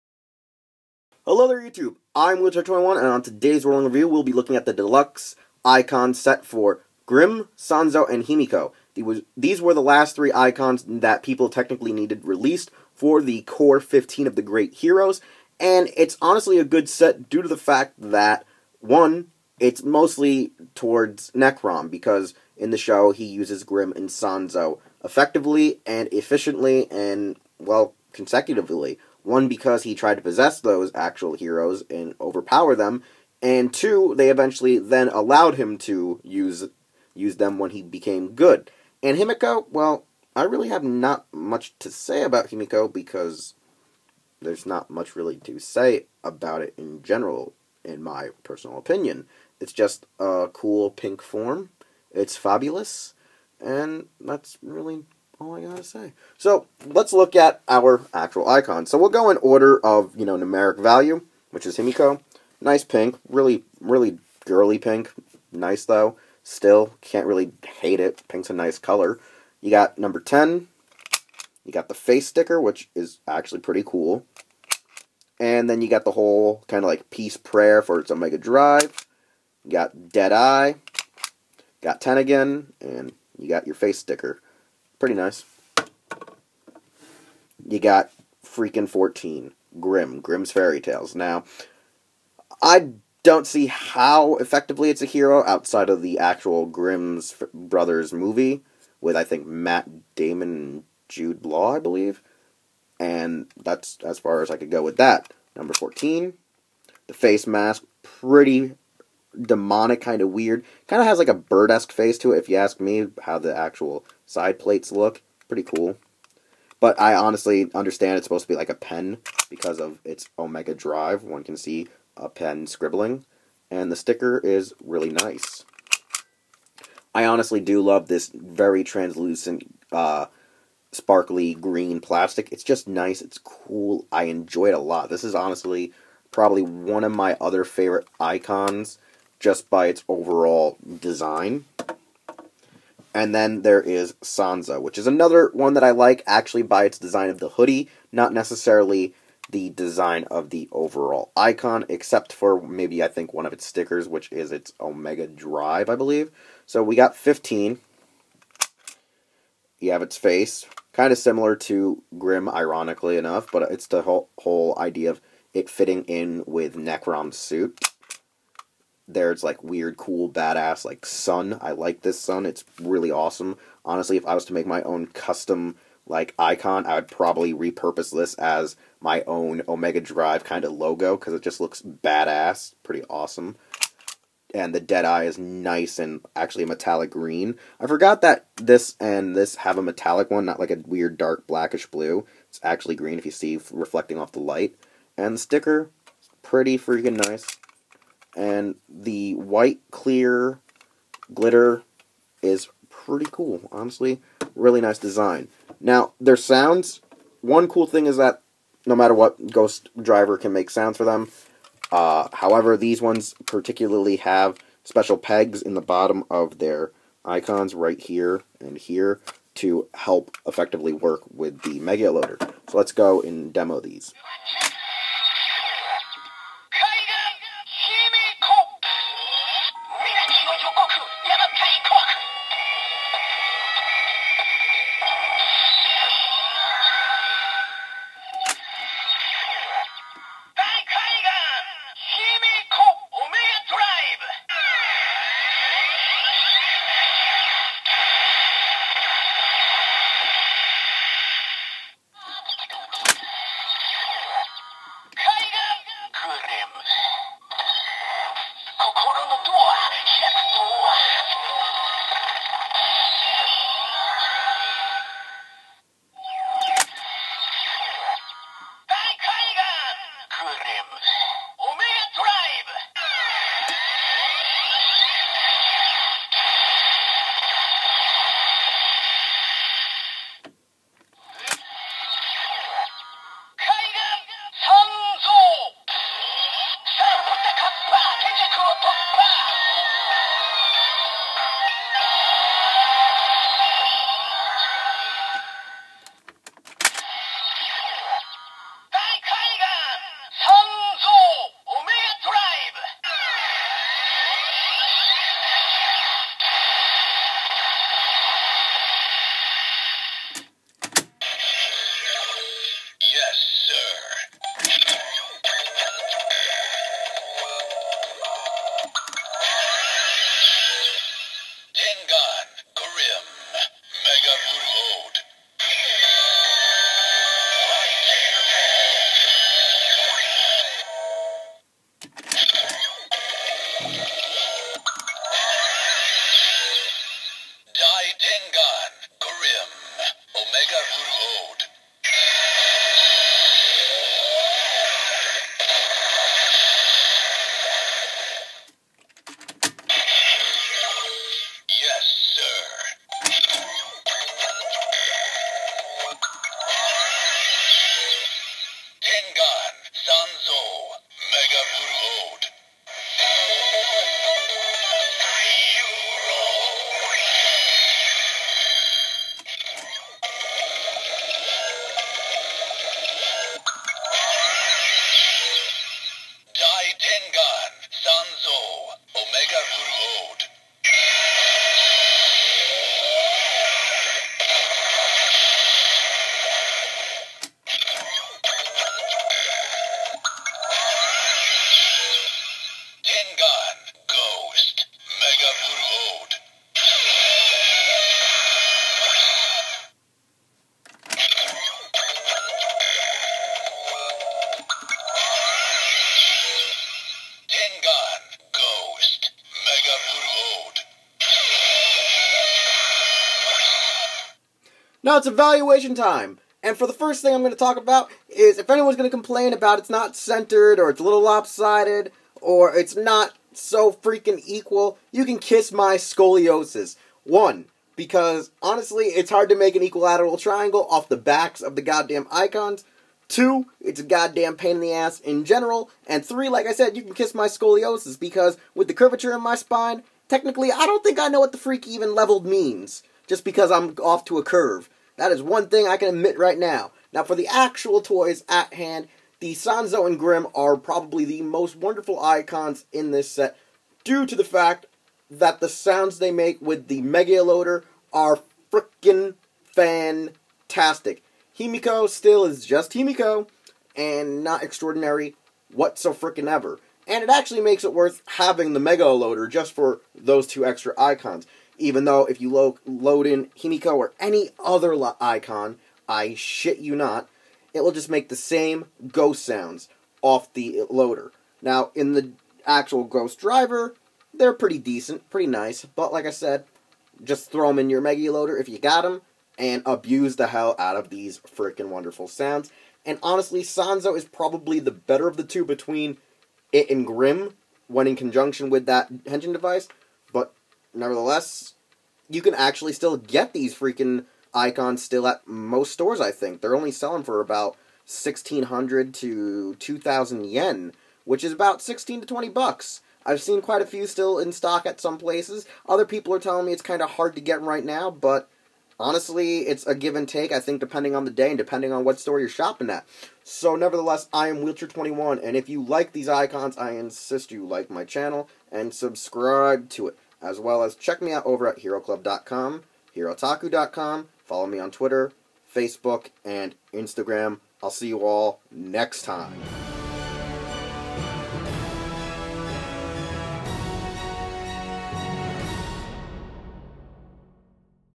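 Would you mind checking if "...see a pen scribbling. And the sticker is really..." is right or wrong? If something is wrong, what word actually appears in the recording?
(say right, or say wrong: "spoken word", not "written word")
right.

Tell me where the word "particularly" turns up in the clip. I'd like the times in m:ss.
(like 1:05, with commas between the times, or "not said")
3:33.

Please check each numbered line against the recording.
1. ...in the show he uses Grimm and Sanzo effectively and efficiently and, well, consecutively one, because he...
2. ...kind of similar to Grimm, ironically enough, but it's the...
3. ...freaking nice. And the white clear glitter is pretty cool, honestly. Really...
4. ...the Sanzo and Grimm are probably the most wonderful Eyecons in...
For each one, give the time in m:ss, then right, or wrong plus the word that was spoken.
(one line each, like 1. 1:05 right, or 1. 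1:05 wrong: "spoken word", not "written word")
1. 0:22 right
2. 2:40 right
3. 3:16 right
4. 7:29 right.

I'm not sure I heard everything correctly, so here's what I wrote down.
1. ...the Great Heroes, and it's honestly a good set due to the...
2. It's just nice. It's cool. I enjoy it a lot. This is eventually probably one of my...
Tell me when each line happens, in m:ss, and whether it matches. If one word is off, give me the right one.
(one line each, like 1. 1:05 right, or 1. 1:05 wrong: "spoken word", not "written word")
1. 0:14 right
2. 2:12 wrong: "honestly", not "eventually".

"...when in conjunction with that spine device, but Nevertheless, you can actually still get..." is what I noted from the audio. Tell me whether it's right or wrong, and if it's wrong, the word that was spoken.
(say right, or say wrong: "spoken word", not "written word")
wrong: "engine", not "spine".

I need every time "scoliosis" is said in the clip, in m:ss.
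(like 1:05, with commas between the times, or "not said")
7:05, 7:17.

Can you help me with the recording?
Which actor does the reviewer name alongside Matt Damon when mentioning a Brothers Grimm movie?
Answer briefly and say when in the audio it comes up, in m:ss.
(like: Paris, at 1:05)
Jude Law, at 1:41.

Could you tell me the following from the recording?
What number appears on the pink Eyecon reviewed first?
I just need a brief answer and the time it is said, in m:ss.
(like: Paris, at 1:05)
10, at 1:09.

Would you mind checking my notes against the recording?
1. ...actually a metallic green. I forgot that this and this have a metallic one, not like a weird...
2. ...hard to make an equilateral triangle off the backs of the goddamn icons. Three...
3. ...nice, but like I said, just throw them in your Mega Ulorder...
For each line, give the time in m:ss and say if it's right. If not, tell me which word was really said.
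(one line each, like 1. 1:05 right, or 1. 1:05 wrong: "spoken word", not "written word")
1. 3:06 right
2. 7:09 wrong: "Two", not "Three"
3. 8:05 right.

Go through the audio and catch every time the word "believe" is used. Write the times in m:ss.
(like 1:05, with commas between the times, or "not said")
1:41, 2:35.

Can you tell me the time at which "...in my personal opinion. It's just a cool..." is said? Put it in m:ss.
0:47.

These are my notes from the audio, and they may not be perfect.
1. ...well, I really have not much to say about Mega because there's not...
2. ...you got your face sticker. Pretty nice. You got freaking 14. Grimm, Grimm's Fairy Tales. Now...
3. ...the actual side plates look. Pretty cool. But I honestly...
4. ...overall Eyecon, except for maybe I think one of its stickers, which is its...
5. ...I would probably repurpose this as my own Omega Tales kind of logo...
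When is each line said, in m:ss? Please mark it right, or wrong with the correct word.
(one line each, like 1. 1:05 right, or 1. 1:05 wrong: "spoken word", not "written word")
1. 0:39 wrong: "Himiko", not "Mega"
2. 1:23 right
3. 1:53 right
4. 2:30 right
5. 2:56 wrong: "Drive", not "Tales".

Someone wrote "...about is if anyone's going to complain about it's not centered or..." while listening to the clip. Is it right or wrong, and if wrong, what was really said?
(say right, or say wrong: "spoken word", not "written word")
right.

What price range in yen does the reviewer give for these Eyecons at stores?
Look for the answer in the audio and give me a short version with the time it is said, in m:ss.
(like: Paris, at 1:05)
1600 to 2000 yen, at 8:28.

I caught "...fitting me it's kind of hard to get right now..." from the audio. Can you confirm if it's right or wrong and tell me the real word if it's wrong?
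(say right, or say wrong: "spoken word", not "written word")
wrong: "telling", not "fitting".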